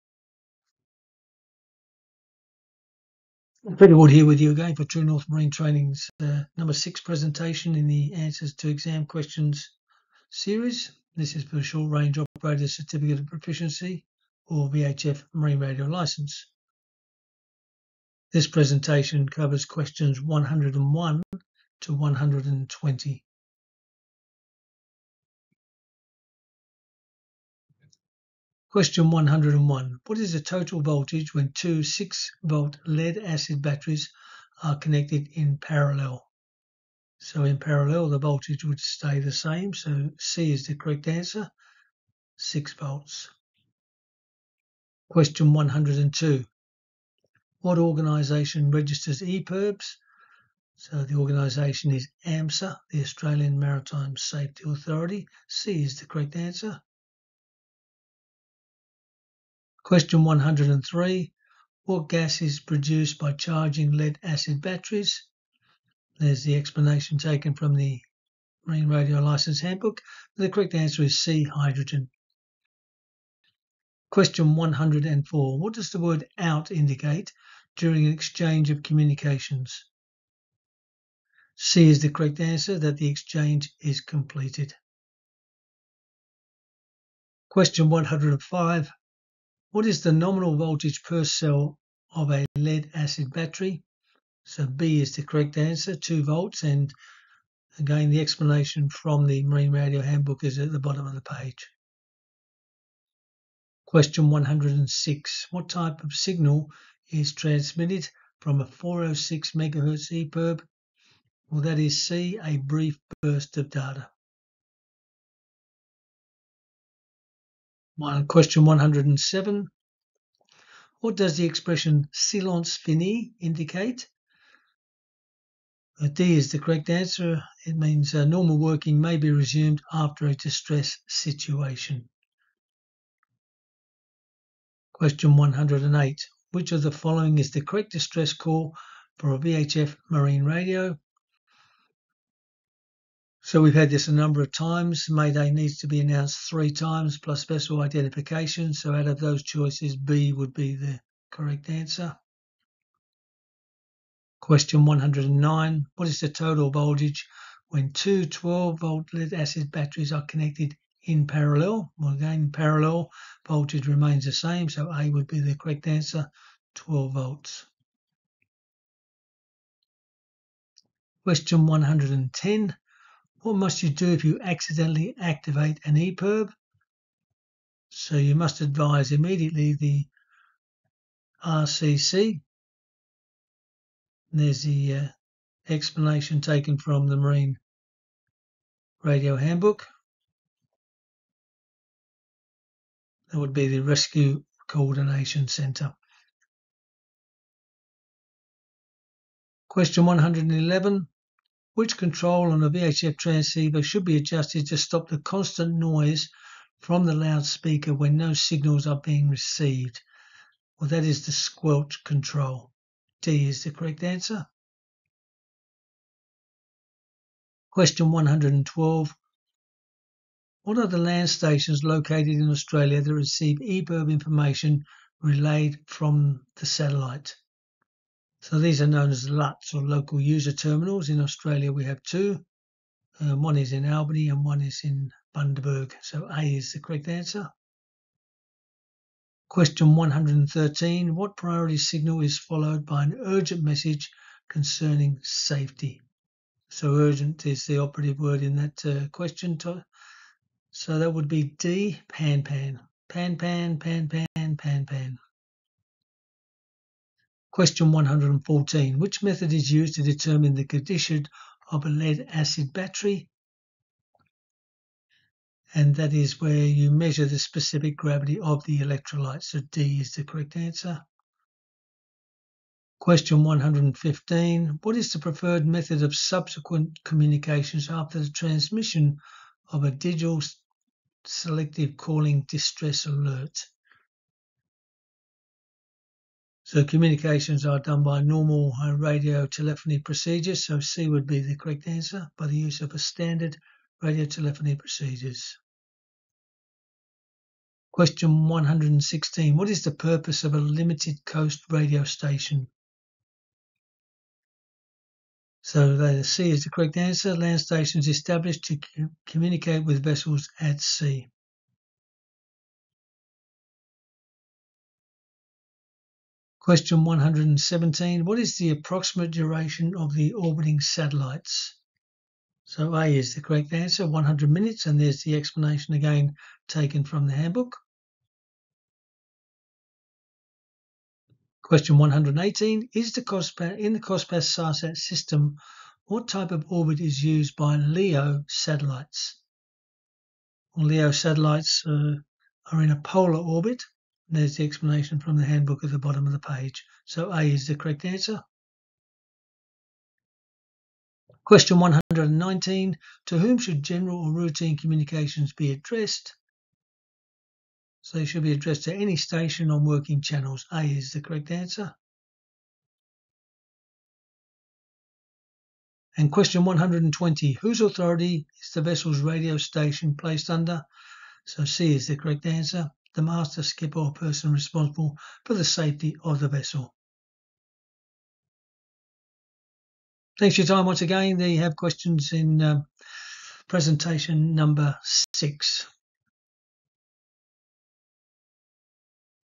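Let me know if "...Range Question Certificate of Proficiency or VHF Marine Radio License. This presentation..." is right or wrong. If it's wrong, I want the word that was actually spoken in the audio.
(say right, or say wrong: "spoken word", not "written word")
wrong: "Operator", not "Question".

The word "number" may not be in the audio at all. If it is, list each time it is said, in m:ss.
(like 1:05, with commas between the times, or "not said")
0:06, 2:24, 6:24.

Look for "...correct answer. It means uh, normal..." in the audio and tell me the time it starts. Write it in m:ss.
2:06.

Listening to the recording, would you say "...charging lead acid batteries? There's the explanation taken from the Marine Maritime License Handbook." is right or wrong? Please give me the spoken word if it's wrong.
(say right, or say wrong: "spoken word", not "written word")
wrong: "Radio", not "Maritime".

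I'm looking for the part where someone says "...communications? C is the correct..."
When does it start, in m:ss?
1:18.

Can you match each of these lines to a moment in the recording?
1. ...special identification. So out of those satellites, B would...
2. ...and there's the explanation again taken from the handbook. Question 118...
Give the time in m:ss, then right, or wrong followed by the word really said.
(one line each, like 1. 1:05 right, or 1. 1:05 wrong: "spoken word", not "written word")
1. 2:27 wrong: "choices", not "satellites"
2. 5:24 right.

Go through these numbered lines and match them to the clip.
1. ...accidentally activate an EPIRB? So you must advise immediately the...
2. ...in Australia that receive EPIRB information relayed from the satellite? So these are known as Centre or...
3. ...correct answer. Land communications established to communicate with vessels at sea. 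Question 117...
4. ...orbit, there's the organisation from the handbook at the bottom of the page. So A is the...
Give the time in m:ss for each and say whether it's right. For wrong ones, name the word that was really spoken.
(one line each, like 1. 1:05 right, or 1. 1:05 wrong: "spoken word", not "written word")
1. 2:54 right
2. 3:42 wrong: "LUTs", not "Centre"
3. 5:06 wrong: "stations", not "communications"
4. 5:43 wrong: "explanation", not "organisation".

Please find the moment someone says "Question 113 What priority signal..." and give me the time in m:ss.
3:59.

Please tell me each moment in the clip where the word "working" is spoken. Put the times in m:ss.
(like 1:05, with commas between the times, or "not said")
2:08, 5:59.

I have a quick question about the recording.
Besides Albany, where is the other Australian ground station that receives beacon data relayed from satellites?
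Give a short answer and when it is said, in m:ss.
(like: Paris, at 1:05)
Bundaberg, at 3:55.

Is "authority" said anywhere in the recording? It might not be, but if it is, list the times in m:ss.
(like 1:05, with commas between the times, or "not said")
0:54, 6:07.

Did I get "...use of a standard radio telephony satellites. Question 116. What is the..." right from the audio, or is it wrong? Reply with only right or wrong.
wrong.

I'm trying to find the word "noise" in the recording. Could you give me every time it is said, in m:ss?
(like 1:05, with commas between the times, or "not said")
3:25.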